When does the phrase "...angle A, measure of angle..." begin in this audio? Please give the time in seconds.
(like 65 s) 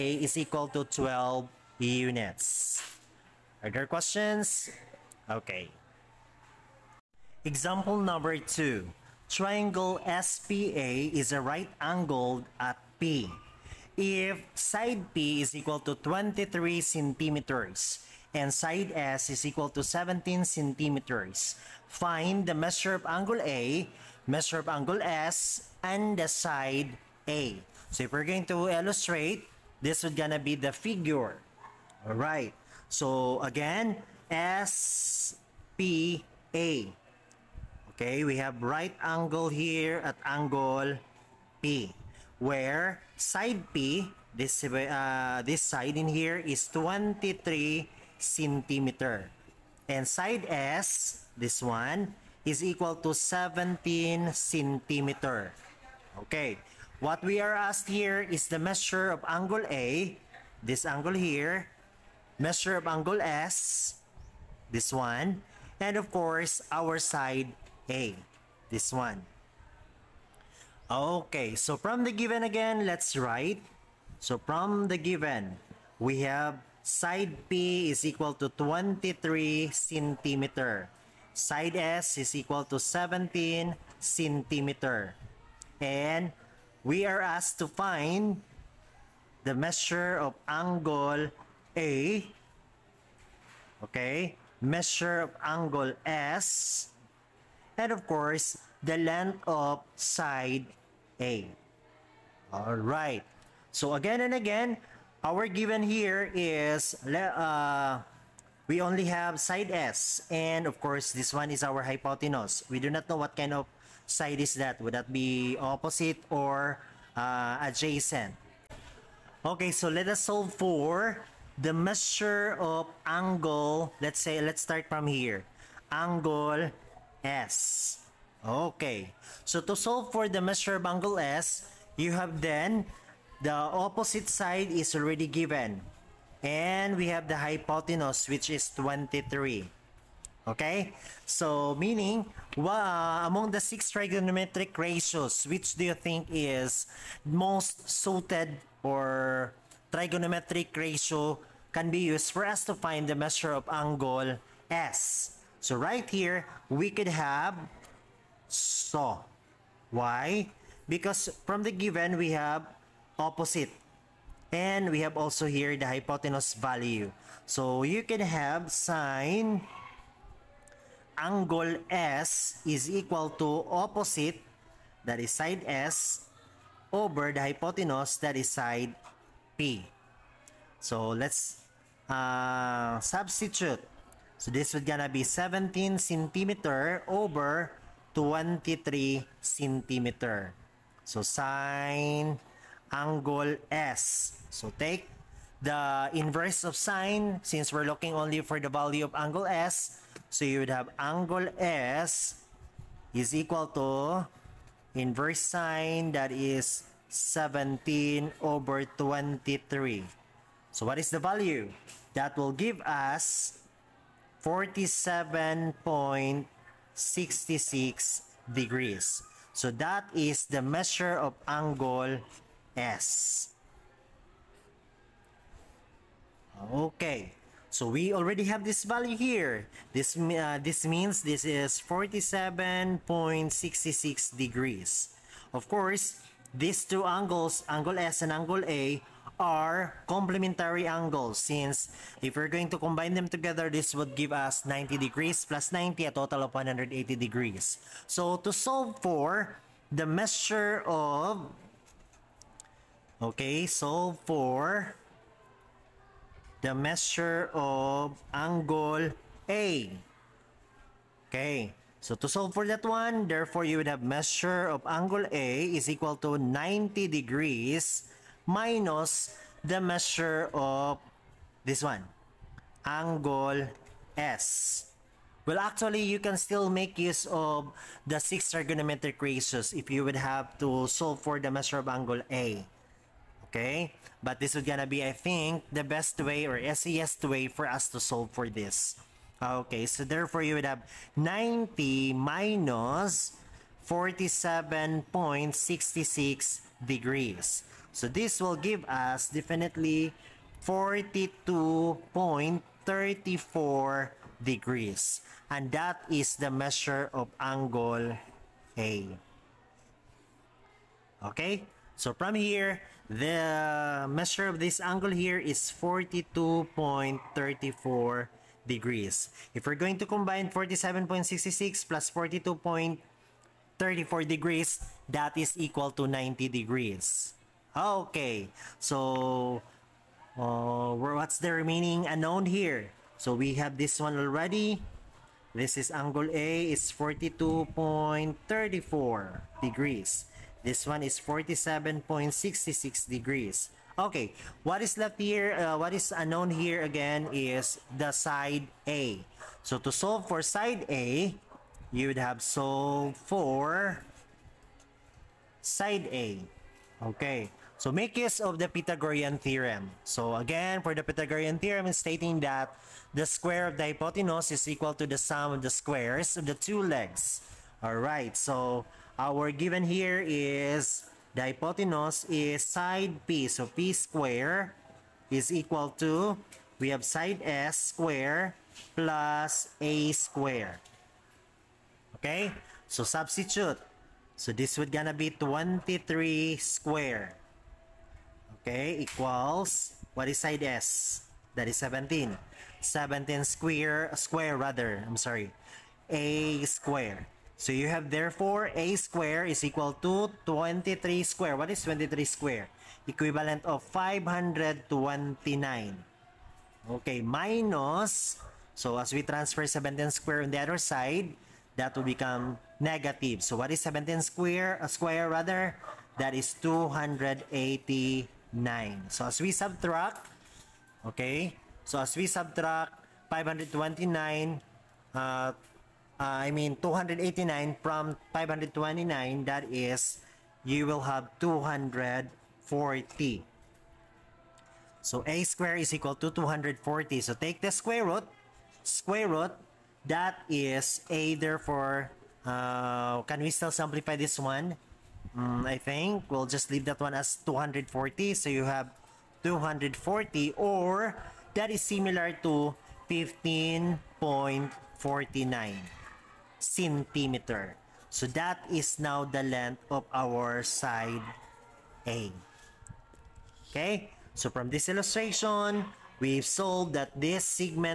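23 s.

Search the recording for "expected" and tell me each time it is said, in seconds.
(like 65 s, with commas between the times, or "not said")
not said.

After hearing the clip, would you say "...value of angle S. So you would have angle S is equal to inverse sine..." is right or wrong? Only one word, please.
right.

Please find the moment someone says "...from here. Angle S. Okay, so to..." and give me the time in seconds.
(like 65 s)
124 s.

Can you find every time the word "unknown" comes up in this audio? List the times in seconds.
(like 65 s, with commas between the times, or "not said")
332 s, 346 s.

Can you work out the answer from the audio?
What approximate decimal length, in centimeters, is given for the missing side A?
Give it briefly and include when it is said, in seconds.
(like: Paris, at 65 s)
15.49 centimeters, at 453 s.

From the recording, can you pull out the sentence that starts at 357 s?
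Okay, so make use of the Pythagorean theorem.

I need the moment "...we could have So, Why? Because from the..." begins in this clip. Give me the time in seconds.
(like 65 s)
156 s.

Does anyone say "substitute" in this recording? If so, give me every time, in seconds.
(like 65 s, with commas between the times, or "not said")
182 s, 383 s.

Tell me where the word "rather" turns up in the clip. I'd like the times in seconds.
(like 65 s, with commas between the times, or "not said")
394 s, 415 s.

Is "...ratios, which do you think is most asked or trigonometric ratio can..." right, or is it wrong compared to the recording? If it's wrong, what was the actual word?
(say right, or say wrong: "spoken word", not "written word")
wrong: "suited", not "asked".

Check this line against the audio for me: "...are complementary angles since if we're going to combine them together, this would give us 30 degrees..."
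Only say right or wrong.
wrong.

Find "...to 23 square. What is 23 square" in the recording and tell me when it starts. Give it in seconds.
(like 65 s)
400 s.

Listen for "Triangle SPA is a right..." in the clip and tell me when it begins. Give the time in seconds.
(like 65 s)
9 s.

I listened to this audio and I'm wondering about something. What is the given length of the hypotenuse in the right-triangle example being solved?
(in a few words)
23 centimeters.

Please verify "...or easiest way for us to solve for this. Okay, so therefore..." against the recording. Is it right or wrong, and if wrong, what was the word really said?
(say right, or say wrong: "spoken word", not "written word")
right.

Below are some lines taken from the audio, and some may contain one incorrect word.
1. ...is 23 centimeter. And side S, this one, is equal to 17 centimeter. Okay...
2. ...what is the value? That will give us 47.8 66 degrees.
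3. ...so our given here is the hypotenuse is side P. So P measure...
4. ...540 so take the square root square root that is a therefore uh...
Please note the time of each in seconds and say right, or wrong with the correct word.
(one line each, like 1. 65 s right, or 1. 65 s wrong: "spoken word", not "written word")
1. 46 s right
2. 210 s right
3. 368 s wrong: "square", not "measure"
4. 436 s wrong: "240", not "540".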